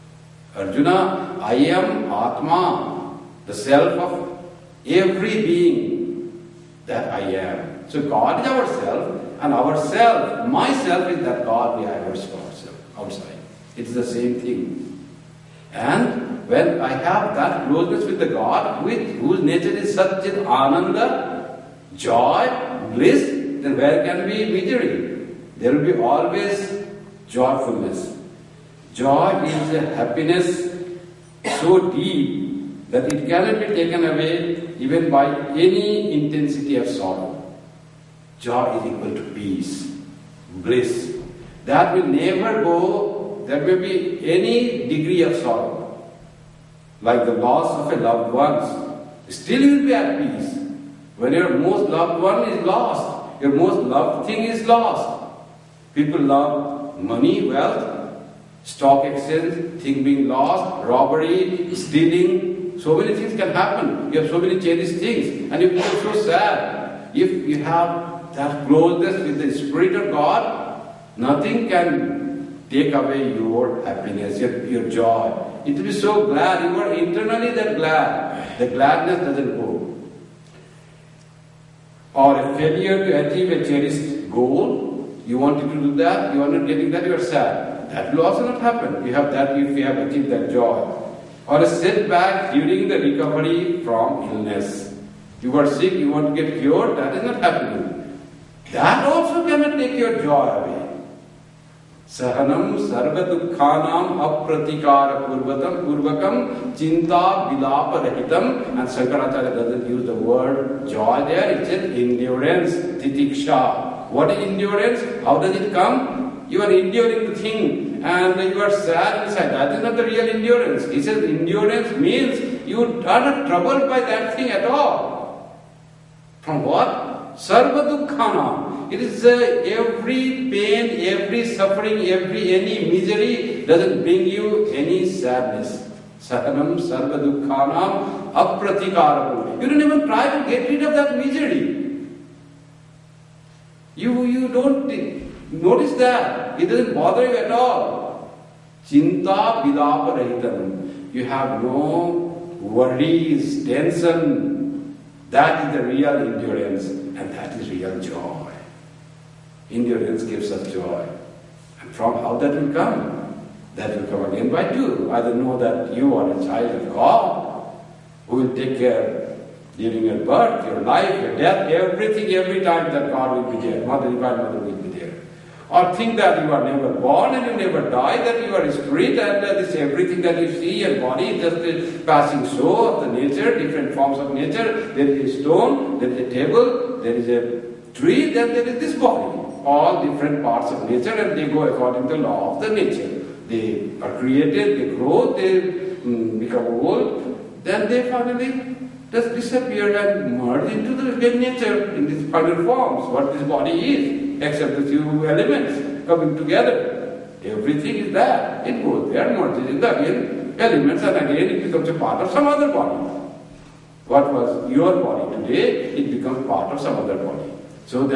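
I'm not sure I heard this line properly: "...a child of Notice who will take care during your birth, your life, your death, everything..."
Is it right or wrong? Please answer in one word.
wrong.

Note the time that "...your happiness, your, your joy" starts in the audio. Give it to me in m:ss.
1:13.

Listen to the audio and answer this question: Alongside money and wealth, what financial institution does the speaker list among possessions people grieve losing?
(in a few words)
Stock exchange.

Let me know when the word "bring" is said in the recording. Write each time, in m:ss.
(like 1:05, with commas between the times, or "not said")
2:14.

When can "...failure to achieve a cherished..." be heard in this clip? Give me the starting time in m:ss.
1:22.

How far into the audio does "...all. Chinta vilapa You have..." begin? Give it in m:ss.
2:27.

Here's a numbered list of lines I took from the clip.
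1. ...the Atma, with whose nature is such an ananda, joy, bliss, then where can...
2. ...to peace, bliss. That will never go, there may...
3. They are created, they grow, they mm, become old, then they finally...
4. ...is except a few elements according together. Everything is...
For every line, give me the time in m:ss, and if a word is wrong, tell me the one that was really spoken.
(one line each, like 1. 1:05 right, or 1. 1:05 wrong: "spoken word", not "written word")
1. 0:18 wrong: "God", not "Atma"
2. 0:39 right
3. 3:13 right
4. 3:24 wrong: "coming", not "according".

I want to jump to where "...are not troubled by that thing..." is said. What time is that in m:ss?
2:03.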